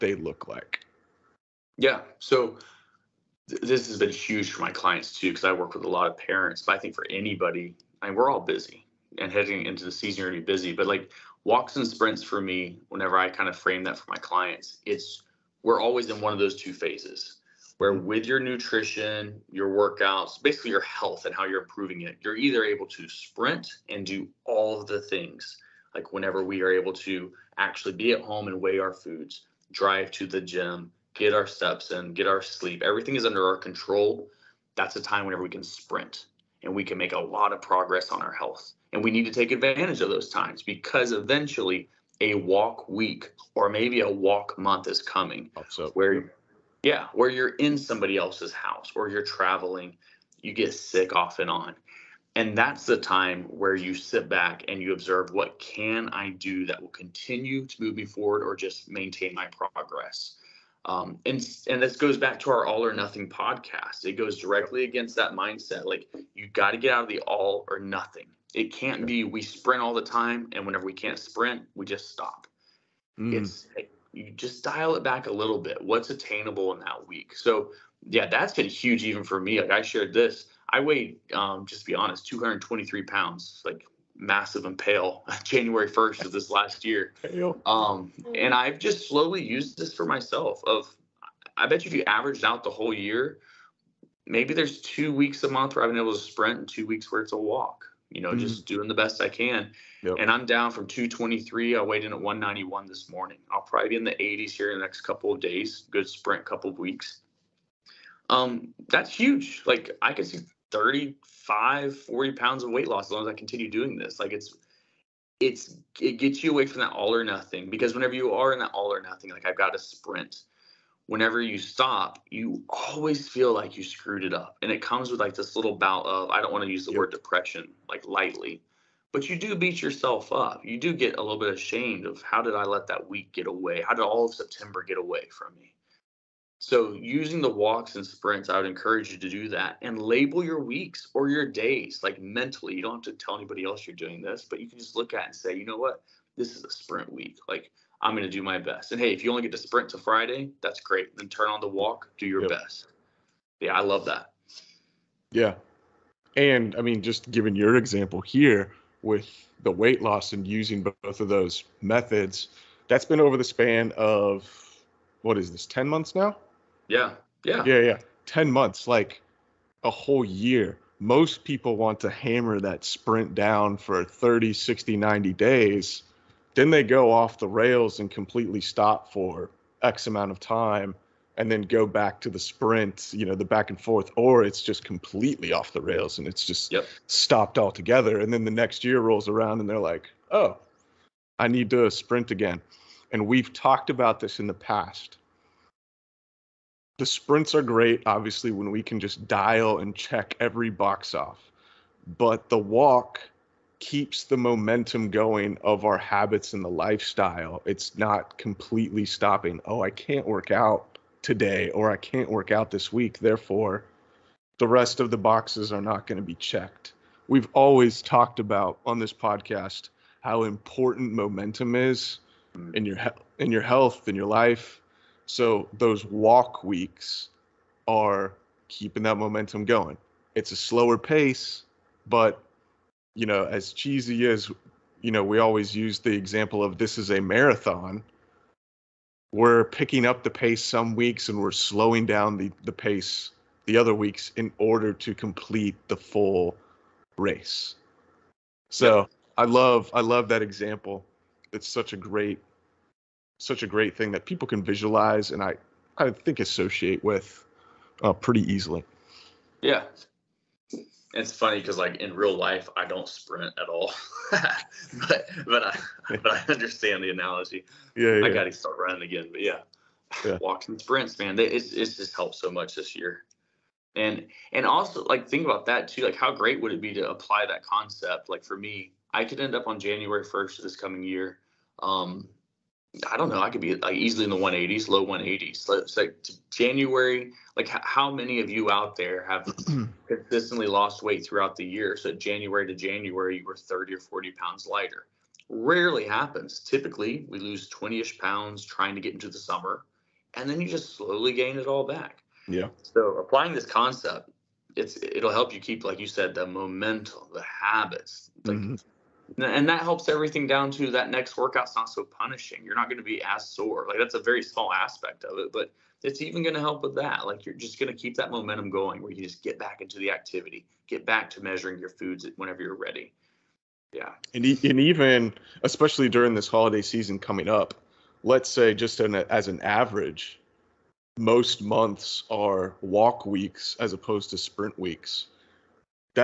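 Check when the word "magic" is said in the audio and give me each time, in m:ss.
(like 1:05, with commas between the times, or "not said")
not said.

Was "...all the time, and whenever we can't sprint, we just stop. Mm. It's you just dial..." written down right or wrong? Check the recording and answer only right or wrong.
right.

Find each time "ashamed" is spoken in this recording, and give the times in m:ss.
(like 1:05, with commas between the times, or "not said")
2:11.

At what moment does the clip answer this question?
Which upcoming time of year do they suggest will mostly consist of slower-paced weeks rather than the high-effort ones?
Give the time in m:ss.
5:26.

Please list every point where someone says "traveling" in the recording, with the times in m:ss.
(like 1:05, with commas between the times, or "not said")
0:49.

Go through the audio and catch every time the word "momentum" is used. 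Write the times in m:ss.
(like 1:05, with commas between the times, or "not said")
3:24, 3:41, 3:49, 5:06, 5:18.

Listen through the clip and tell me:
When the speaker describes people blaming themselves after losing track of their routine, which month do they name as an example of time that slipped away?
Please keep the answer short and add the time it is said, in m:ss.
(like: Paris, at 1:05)
September, at 2:14.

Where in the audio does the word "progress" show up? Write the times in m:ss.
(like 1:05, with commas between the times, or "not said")
0:37, 0:59.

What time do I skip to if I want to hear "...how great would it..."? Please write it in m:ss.
4:36.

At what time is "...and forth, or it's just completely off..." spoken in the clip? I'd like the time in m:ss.
3:03.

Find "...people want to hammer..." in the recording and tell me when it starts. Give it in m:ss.
2:51.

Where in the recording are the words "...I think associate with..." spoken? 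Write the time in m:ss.
4:15.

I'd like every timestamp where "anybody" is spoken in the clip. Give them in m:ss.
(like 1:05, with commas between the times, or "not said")
0:07, 2:23.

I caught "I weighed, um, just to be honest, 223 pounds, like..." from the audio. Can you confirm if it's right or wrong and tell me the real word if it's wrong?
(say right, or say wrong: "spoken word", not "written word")
right.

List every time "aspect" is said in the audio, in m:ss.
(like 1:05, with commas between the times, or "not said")
5:14.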